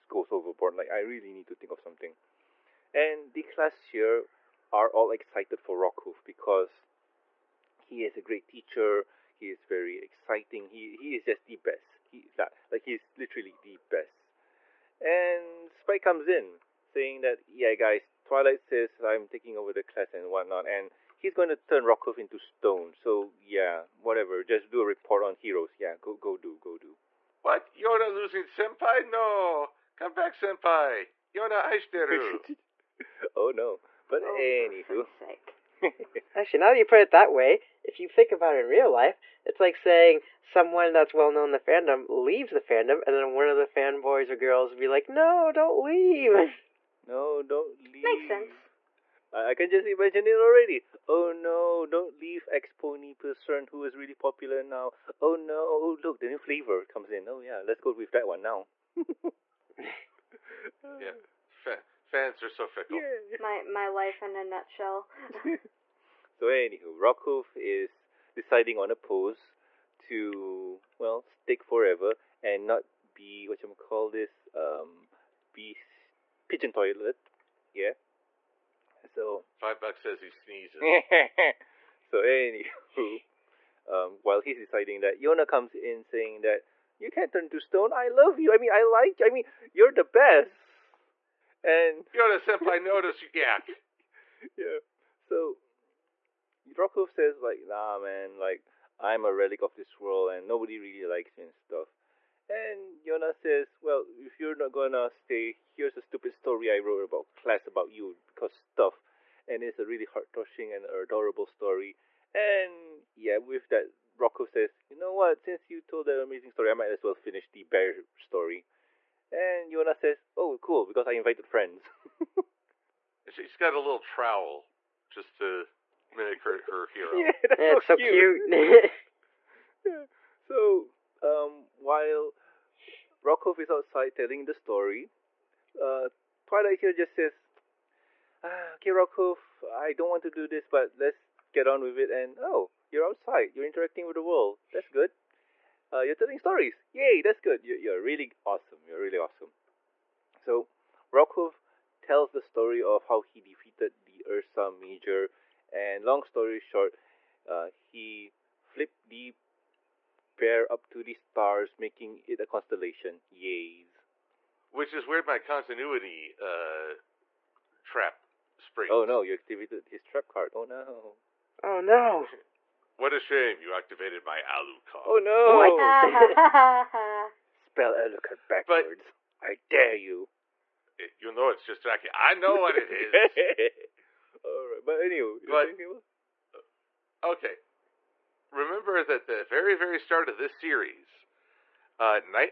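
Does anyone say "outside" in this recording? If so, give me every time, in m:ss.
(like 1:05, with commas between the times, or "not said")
2:13, 2:23.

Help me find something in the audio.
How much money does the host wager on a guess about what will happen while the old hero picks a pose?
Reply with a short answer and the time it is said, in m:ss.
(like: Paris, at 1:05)
5 dollars, at 1:19.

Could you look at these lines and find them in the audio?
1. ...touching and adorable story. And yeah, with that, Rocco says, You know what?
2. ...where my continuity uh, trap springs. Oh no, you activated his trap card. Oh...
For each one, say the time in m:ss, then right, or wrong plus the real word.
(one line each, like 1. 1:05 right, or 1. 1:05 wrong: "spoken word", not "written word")
1. 1:50 right
2. 2:45 right.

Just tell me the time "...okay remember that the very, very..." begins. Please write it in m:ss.
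3:07.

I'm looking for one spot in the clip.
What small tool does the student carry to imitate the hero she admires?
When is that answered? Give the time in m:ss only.
2:03.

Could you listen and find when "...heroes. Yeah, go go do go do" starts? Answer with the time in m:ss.
0:25.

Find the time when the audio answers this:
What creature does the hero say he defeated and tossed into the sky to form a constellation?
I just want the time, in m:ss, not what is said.
2:34.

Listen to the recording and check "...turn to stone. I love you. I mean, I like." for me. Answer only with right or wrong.
right.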